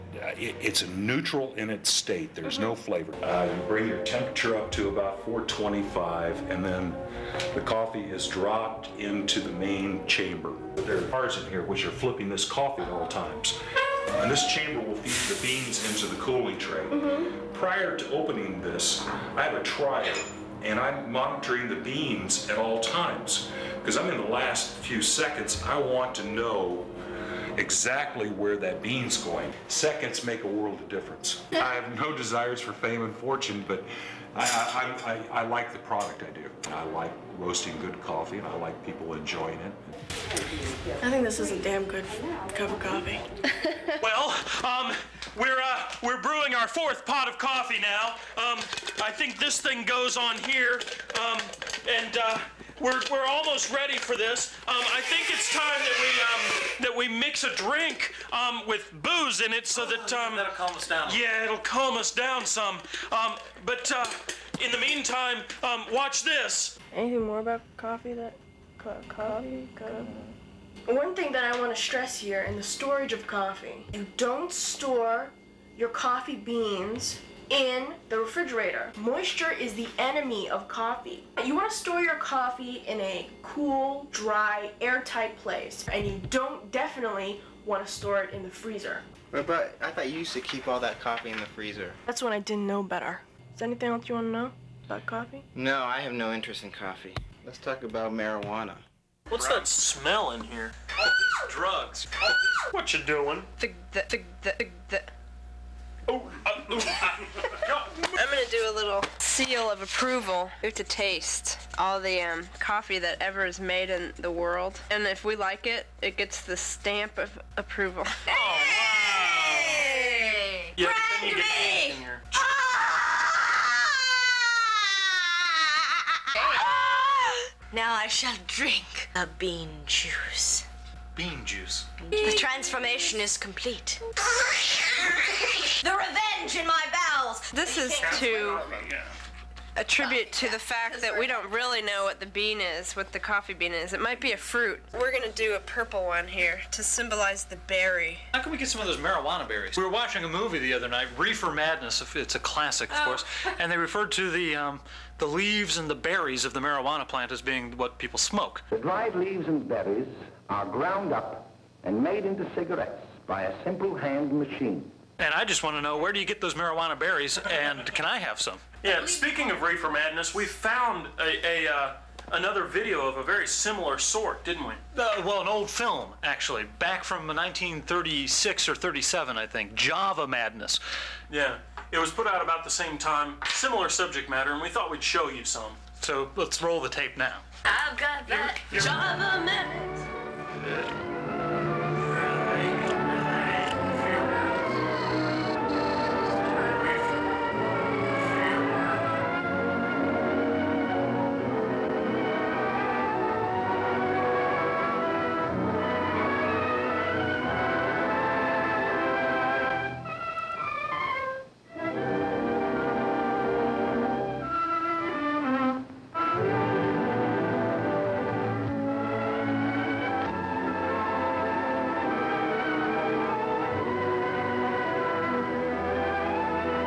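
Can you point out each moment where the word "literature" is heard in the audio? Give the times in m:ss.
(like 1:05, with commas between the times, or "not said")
not said.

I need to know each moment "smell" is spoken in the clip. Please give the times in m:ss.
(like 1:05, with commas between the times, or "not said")
1:39.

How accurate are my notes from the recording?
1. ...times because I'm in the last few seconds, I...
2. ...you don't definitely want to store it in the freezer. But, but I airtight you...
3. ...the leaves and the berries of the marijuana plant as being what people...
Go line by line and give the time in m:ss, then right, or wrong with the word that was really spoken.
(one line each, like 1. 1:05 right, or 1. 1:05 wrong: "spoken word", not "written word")
1. 0:22 right
2. 1:26 wrong: "thought", not "airtight"
3. 2:35 right.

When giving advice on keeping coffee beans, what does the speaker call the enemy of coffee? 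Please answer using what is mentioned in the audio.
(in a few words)
Moisture.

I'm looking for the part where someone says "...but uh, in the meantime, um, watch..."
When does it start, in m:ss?
1:03.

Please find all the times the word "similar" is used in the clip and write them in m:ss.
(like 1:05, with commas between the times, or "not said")
2:53, 3:03.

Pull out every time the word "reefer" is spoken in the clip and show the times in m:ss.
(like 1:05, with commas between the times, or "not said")
2:31, 2:49.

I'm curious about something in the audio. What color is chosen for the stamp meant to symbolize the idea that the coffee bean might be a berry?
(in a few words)
Purple.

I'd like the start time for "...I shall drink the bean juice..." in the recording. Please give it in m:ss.
2:07.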